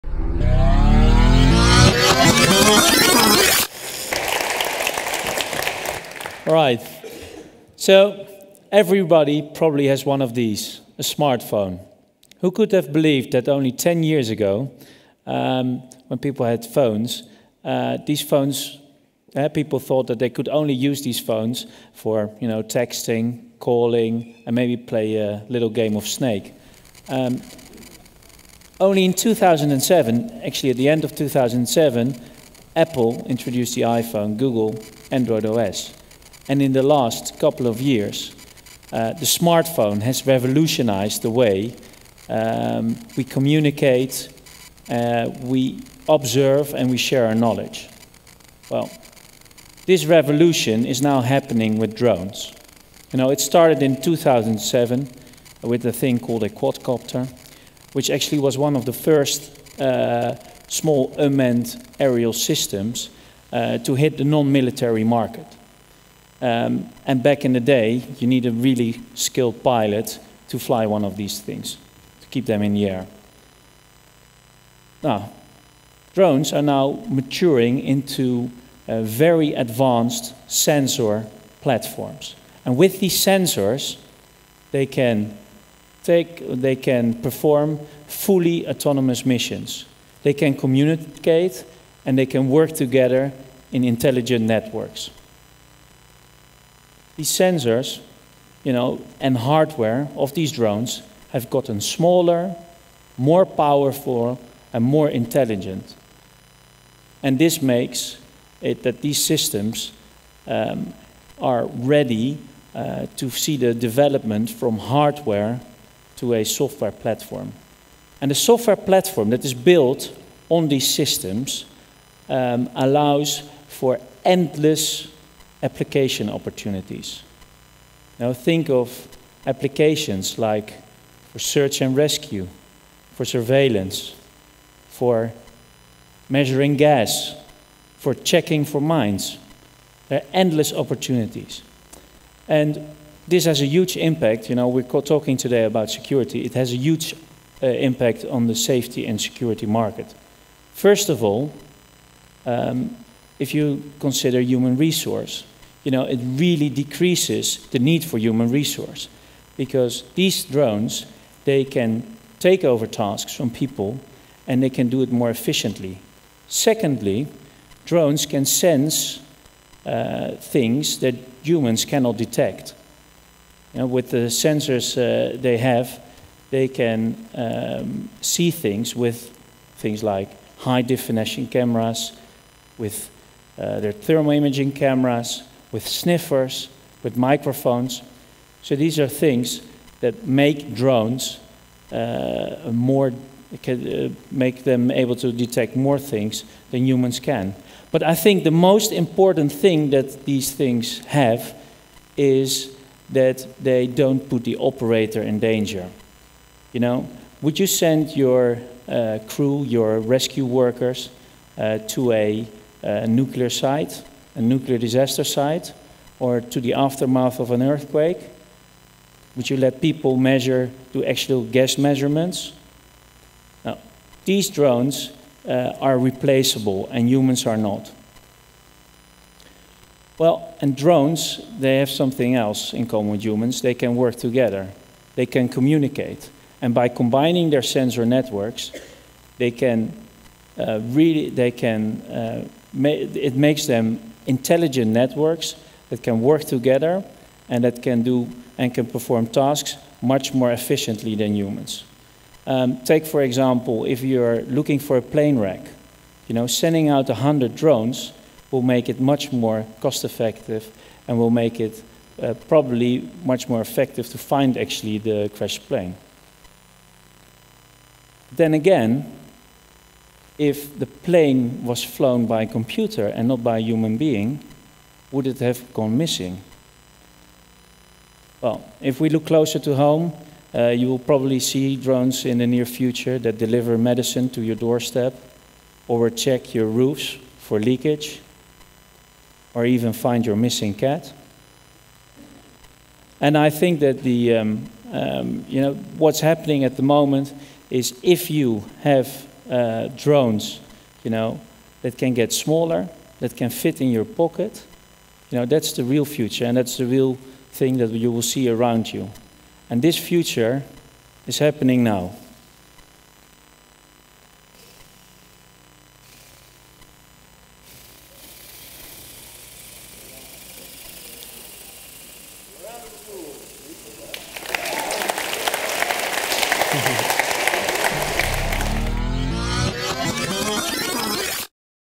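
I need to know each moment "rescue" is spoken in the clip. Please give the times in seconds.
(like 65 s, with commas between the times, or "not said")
131 s, 209 s.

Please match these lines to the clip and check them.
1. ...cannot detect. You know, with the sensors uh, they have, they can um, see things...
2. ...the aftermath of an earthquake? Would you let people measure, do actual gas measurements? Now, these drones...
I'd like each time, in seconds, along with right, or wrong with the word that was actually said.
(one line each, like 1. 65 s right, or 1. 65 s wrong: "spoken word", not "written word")
1. 171 s right
2. 216 s right.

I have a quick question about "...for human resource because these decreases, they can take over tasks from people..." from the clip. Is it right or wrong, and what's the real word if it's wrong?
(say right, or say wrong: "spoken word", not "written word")
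wrong: "drones", not "decreases".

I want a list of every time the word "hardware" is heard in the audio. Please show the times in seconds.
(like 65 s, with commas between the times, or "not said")
99 s, 114 s.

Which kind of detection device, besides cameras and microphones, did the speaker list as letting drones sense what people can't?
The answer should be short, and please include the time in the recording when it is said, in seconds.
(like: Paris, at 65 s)
sniffers, at 185 s.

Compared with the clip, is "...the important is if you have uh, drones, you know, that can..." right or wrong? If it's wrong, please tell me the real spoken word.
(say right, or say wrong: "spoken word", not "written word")
wrong: "moment", not "important".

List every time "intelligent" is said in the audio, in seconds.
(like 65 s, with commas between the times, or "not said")
93 s, 105 s, 244 s.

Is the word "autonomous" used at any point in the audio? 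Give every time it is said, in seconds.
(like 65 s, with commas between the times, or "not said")
88 s.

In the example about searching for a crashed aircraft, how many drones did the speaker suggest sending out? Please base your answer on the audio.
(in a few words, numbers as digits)
100.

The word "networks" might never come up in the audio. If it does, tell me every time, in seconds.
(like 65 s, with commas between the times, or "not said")
94 s, 238 s, 244 s.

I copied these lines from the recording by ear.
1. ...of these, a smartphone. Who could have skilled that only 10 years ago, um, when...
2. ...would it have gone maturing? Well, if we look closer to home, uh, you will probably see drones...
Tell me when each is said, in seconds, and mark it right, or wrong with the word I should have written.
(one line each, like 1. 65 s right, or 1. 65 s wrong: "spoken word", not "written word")
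1. 10 s wrong: "believed", not "skilled"
2. 275 s wrong: "missing", not "maturing".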